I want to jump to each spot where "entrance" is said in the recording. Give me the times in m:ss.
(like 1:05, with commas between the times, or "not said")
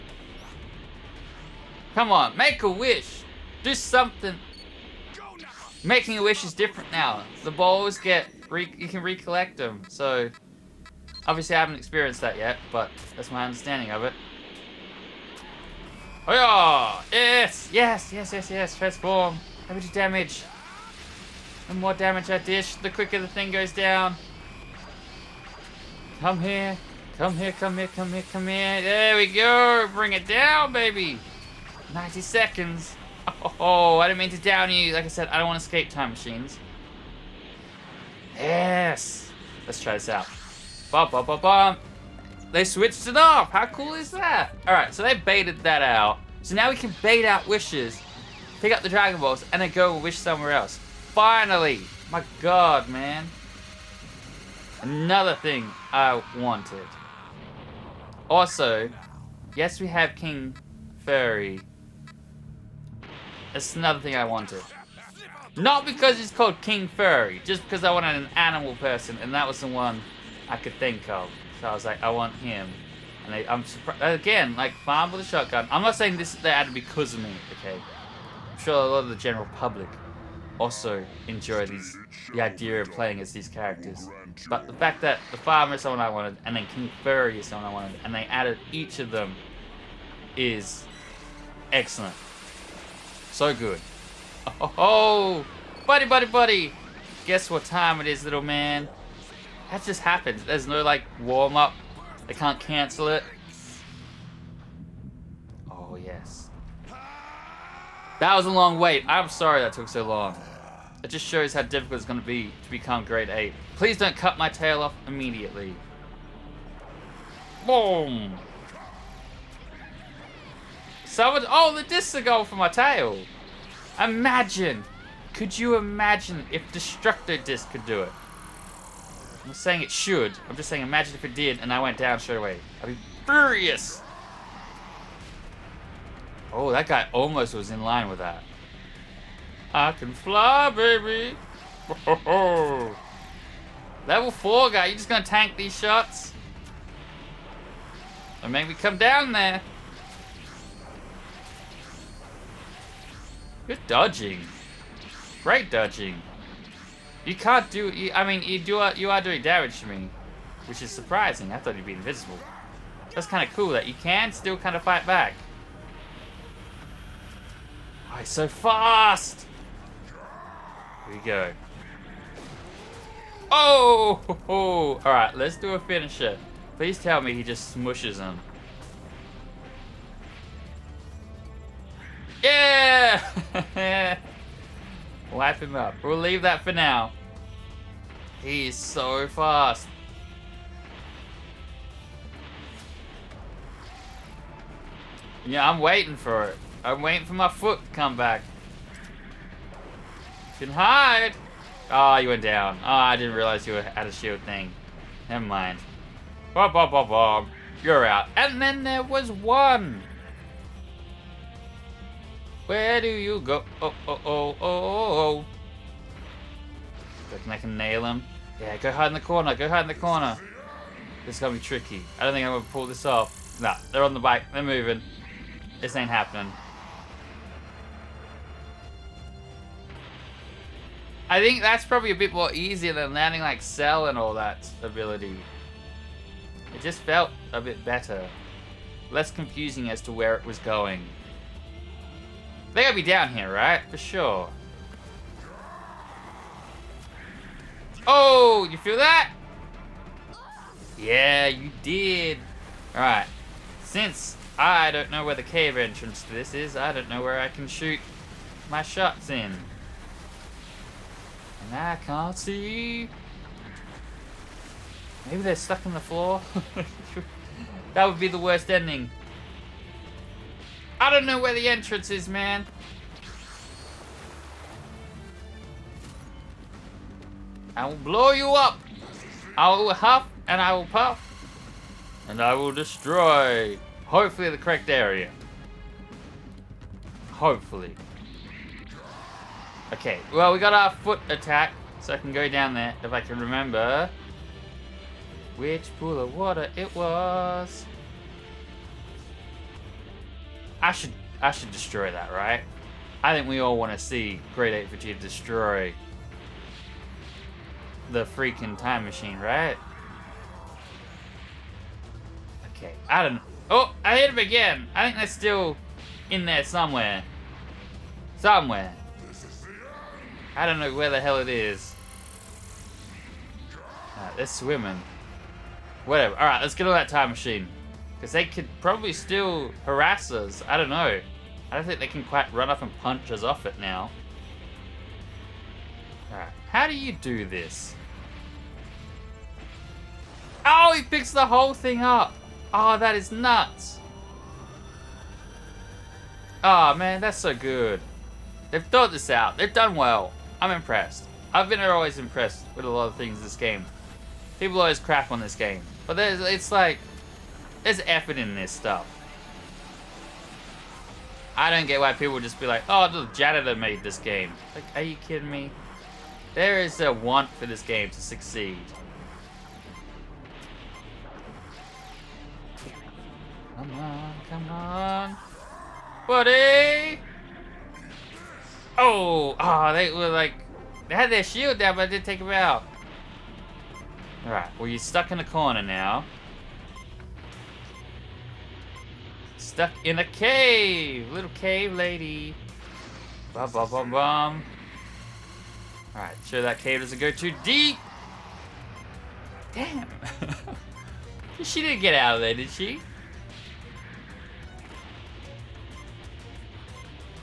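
4:15, 4:31.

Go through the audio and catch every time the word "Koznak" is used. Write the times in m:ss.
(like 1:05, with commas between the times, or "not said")
not said.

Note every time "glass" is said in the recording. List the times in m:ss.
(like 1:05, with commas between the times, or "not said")
not said.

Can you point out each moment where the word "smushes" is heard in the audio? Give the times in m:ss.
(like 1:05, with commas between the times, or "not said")
2:57.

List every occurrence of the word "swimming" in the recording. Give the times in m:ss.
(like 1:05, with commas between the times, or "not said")
5:24.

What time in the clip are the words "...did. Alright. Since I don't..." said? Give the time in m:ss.
4:11.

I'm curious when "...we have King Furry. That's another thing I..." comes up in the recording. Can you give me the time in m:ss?
0:59.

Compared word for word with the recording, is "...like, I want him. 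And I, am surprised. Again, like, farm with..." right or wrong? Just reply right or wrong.
right.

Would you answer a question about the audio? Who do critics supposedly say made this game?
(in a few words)
the janitor.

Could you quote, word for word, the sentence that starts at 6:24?
Alright, well, you're stuck in the corner now.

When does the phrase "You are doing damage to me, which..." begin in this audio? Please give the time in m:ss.
2:38.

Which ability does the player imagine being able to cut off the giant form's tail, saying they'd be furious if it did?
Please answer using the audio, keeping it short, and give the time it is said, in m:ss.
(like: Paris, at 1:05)
Destructo Disc, at 2:06.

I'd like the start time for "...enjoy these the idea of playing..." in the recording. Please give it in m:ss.
1:21.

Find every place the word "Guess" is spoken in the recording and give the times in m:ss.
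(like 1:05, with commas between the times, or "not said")
1:37.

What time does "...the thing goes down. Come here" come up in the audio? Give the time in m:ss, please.
0:23.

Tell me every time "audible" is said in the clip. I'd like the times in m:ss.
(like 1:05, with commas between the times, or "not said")
not said.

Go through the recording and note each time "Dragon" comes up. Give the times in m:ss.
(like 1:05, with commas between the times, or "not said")
0:48.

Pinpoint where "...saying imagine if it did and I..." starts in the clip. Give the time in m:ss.
2:10.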